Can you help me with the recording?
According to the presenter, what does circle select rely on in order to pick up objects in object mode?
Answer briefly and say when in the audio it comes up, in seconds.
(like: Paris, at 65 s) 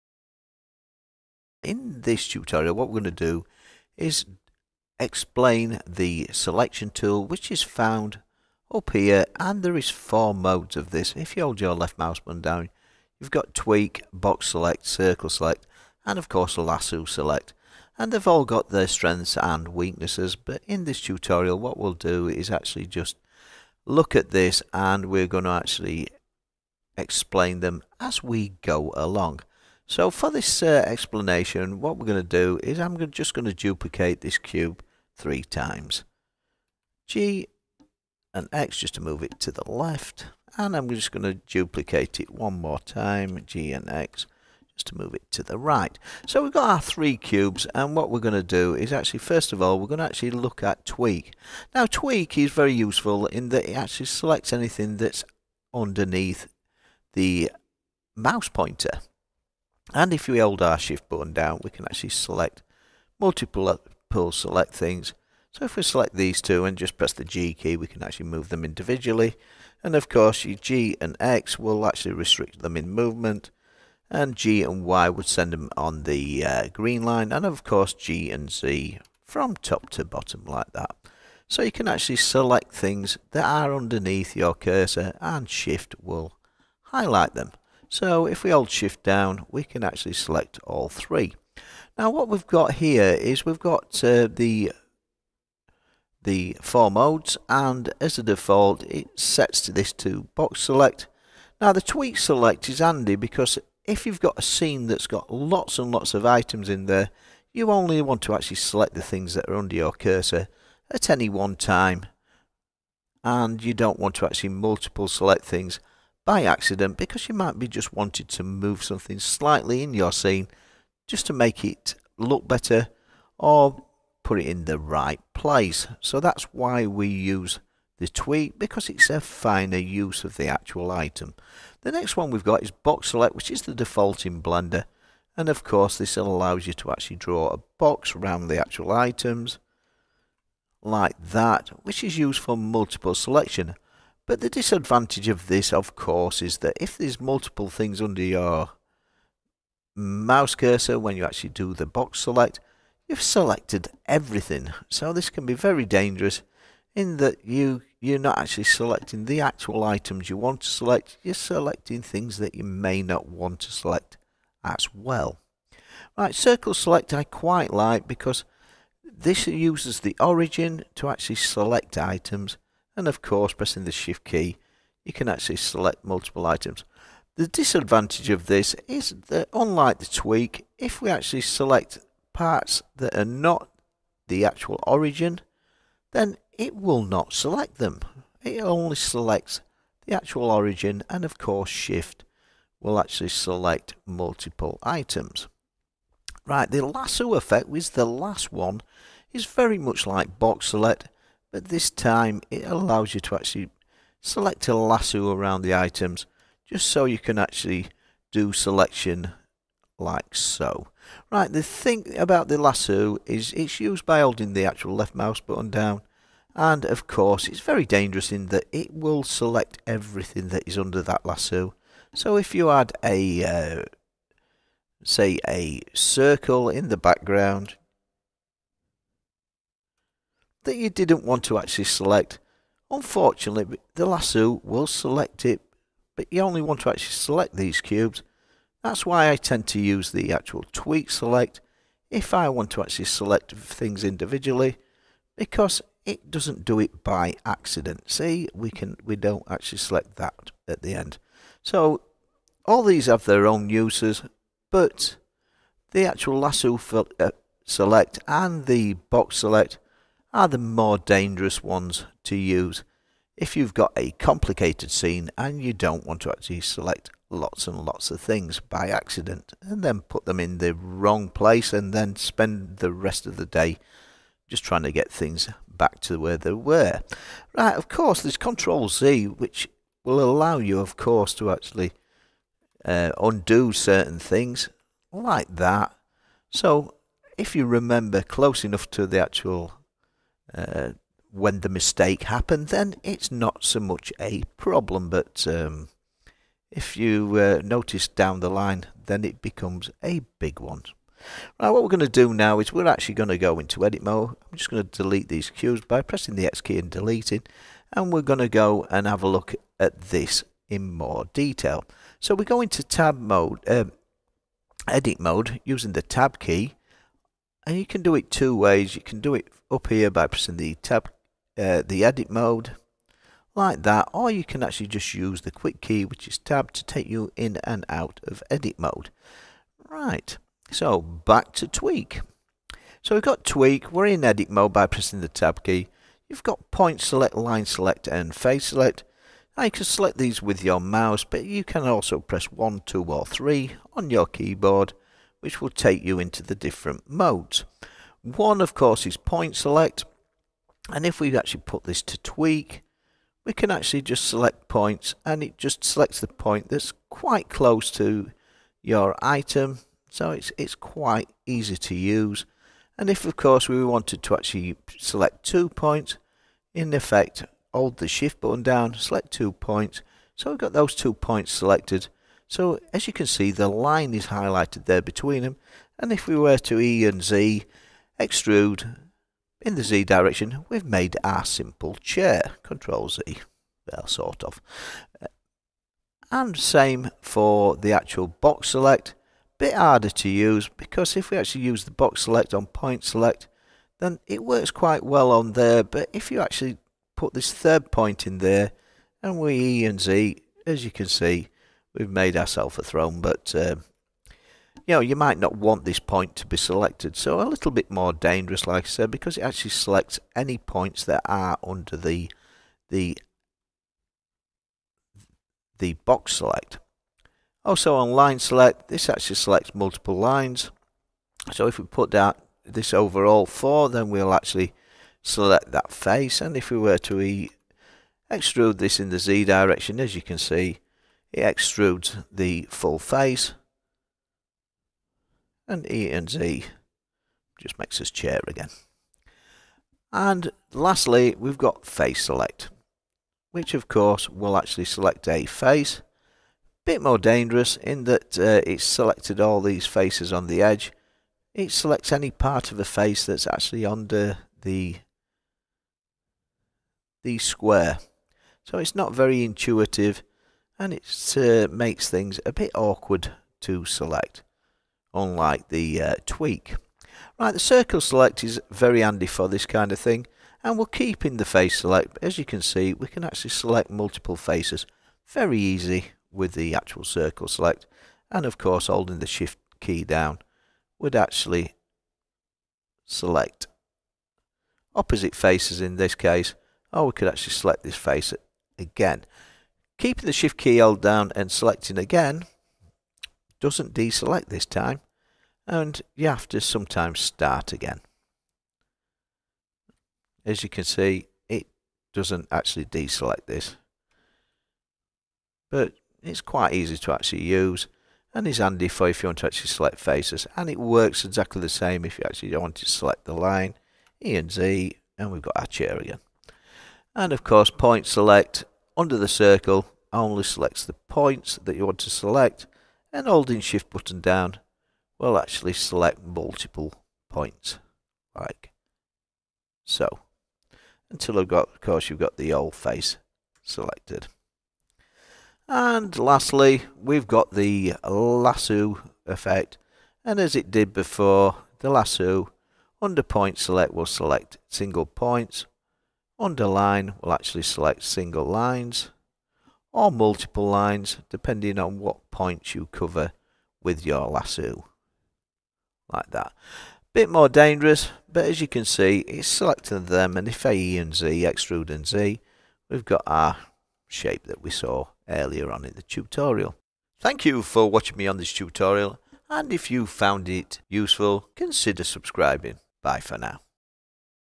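The origin, at 169 s.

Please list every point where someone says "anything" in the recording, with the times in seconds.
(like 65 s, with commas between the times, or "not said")
54 s.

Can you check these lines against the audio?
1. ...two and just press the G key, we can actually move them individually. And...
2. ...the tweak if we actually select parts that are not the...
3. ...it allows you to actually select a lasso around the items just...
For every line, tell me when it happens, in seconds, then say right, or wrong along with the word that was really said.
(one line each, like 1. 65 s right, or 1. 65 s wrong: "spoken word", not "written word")
1. 66 s right
2. 179 s right
3. 202 s right.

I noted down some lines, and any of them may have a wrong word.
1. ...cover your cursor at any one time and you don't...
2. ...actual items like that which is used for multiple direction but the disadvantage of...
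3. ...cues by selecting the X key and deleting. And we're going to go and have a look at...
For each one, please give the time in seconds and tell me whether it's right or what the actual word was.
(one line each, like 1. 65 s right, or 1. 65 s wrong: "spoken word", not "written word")
1. 109 s wrong: "under", not "cover"
2. 138 s wrong: "selection", not "direction"
3. 305 s wrong: "pressing", not "selecting".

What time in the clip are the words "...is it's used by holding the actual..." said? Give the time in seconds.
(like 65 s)
213 s.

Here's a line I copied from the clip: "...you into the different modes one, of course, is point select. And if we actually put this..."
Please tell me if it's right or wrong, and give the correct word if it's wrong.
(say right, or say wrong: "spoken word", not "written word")
right.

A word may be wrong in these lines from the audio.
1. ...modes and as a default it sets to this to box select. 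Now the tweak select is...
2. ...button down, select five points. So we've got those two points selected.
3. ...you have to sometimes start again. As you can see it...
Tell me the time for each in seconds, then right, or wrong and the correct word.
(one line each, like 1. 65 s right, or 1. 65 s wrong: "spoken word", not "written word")
1. 96 s right
2. 368 s wrong: "two", not "five"
3. 496 s right.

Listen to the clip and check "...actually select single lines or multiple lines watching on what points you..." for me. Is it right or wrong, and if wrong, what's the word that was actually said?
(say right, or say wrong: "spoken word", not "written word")
wrong: "depending", not "watching".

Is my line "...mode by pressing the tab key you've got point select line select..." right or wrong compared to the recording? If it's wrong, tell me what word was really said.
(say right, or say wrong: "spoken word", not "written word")
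right.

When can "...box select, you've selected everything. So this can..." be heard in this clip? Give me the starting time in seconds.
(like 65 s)
151 s.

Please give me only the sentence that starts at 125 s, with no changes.
So that's why we use the tweak because it's a finer use of the actual item.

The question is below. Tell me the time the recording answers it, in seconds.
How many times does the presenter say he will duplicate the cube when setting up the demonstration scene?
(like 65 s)
35 s.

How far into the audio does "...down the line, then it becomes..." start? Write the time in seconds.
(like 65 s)
298 s.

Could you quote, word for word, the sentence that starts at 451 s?
It selects any part of a face that's actually under the the square.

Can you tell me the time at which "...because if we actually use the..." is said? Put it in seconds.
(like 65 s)
390 s.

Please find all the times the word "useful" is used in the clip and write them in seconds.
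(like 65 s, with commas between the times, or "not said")
52 s, 570 s.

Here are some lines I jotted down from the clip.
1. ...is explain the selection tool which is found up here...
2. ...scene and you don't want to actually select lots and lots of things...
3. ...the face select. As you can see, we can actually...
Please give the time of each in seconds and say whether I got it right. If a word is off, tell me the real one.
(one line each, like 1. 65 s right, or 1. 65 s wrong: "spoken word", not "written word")
1. 3 s right
2. 264 s right
3. 471 s right.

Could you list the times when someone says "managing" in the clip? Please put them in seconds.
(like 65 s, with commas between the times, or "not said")
not said.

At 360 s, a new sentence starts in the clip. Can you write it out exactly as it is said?
So it's, it's quite easy to use.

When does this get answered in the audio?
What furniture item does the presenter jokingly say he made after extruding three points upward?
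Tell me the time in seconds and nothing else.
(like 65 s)
402 s.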